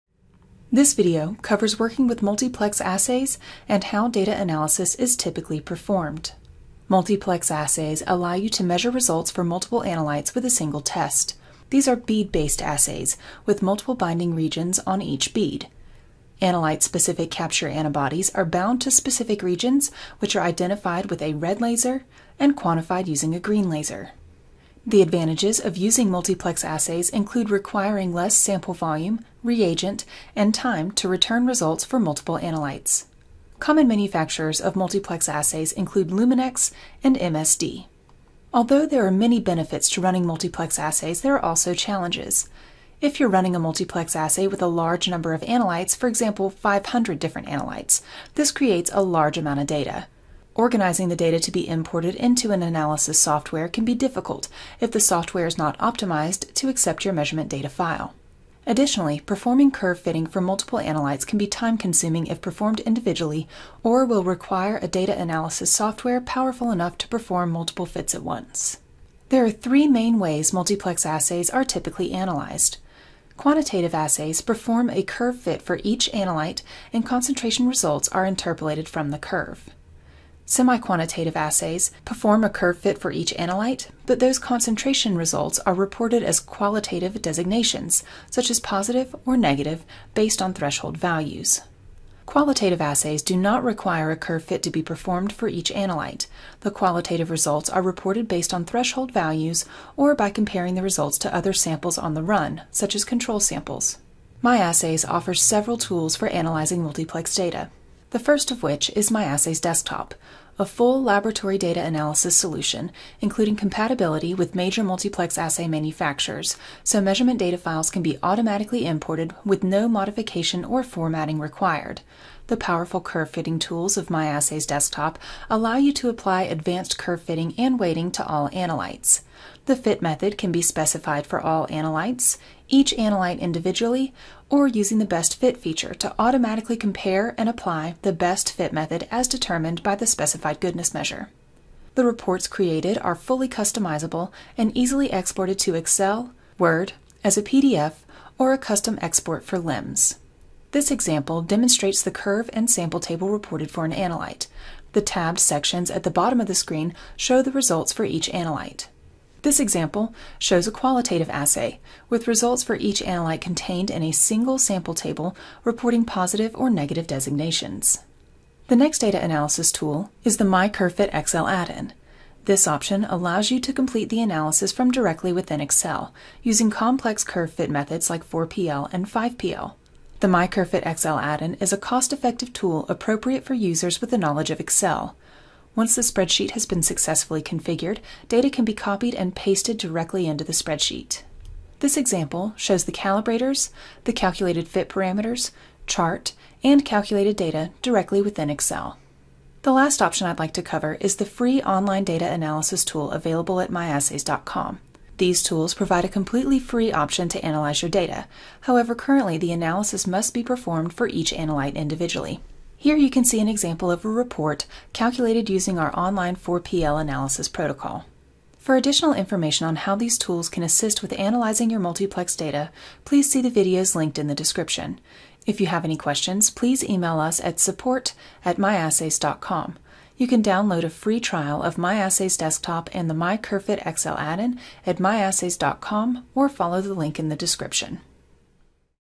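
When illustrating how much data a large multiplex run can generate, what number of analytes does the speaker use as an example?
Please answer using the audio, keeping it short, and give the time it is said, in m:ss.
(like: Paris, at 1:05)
500, at 0:46.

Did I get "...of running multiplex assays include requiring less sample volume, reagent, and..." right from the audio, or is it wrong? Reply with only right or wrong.
wrong.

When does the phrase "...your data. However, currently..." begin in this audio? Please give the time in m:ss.
3:27.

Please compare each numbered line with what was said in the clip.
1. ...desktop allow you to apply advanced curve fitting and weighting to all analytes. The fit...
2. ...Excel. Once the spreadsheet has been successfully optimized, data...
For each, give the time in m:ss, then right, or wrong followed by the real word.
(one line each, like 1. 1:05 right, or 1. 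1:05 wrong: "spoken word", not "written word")
1. 2:04 right
2. 3:04 wrong: "configured", not "optimized".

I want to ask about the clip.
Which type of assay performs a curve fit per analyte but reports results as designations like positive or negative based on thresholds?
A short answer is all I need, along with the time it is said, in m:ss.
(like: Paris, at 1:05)
Semi-quantitative, at 1:20.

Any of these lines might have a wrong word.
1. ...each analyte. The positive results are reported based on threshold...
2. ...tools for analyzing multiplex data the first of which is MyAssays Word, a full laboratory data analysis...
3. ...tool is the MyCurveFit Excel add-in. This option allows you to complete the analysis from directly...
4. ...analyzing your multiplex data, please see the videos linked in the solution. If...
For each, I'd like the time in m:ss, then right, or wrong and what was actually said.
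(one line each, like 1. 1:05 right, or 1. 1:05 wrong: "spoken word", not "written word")
1. 1:35 wrong: "qualitative", not "positive"
2. 1:45 wrong: "Desktop", not "Word"
3. 2:49 right
4. 3:41 wrong: "description", not "solution".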